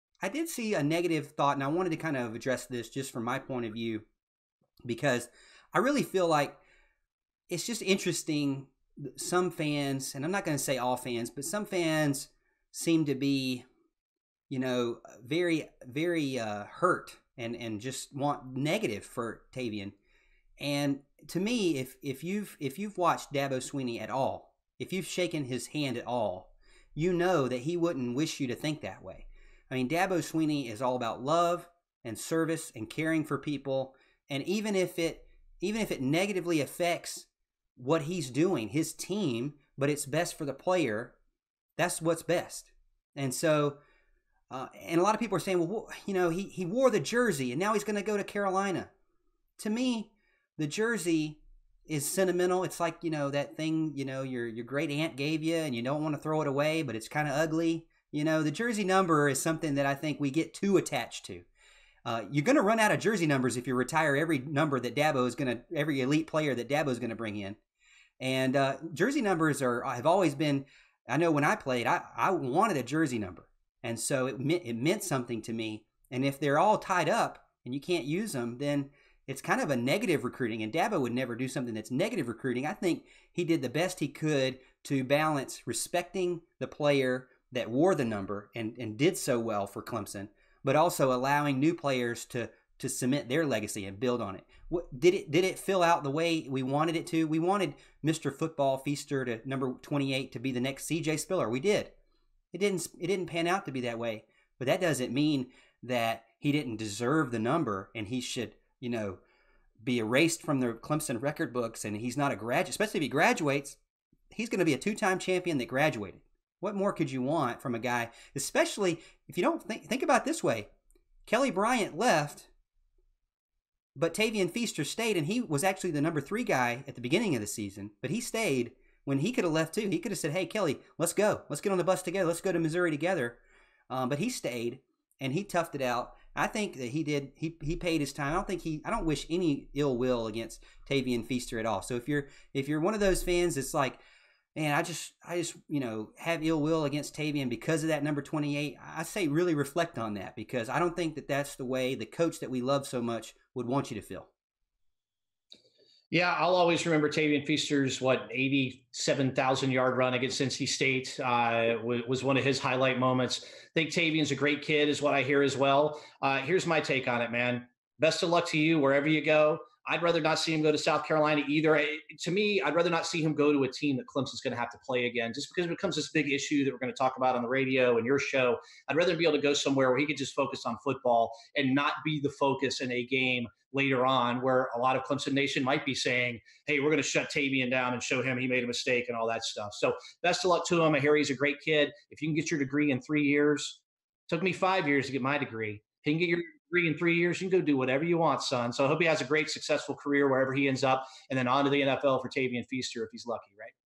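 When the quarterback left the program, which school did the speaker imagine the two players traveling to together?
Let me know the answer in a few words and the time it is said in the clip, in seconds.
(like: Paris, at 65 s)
Missouri, at 132 s.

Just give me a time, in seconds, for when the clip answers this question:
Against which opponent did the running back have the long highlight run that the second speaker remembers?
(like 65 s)
160 s.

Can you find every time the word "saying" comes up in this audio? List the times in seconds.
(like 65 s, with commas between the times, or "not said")
45 s, 185 s.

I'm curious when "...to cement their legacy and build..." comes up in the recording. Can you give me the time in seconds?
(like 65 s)
92 s.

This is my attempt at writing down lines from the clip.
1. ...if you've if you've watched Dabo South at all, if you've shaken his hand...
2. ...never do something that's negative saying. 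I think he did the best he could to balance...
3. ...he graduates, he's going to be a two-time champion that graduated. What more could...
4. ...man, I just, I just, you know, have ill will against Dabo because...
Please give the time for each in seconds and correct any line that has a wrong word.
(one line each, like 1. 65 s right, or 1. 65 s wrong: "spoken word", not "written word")
1. 22 s wrong: "Swinney", not "South"
2. 81 s wrong: "recruiting", not "saying"
3. 113 s right
4. 144 s wrong: "Tavien", not "Dabo".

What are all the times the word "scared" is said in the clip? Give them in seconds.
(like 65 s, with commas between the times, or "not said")
not said.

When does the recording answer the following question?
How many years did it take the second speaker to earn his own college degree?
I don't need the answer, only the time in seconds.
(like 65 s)
194 s.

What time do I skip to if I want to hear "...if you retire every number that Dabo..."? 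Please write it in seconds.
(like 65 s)
63 s.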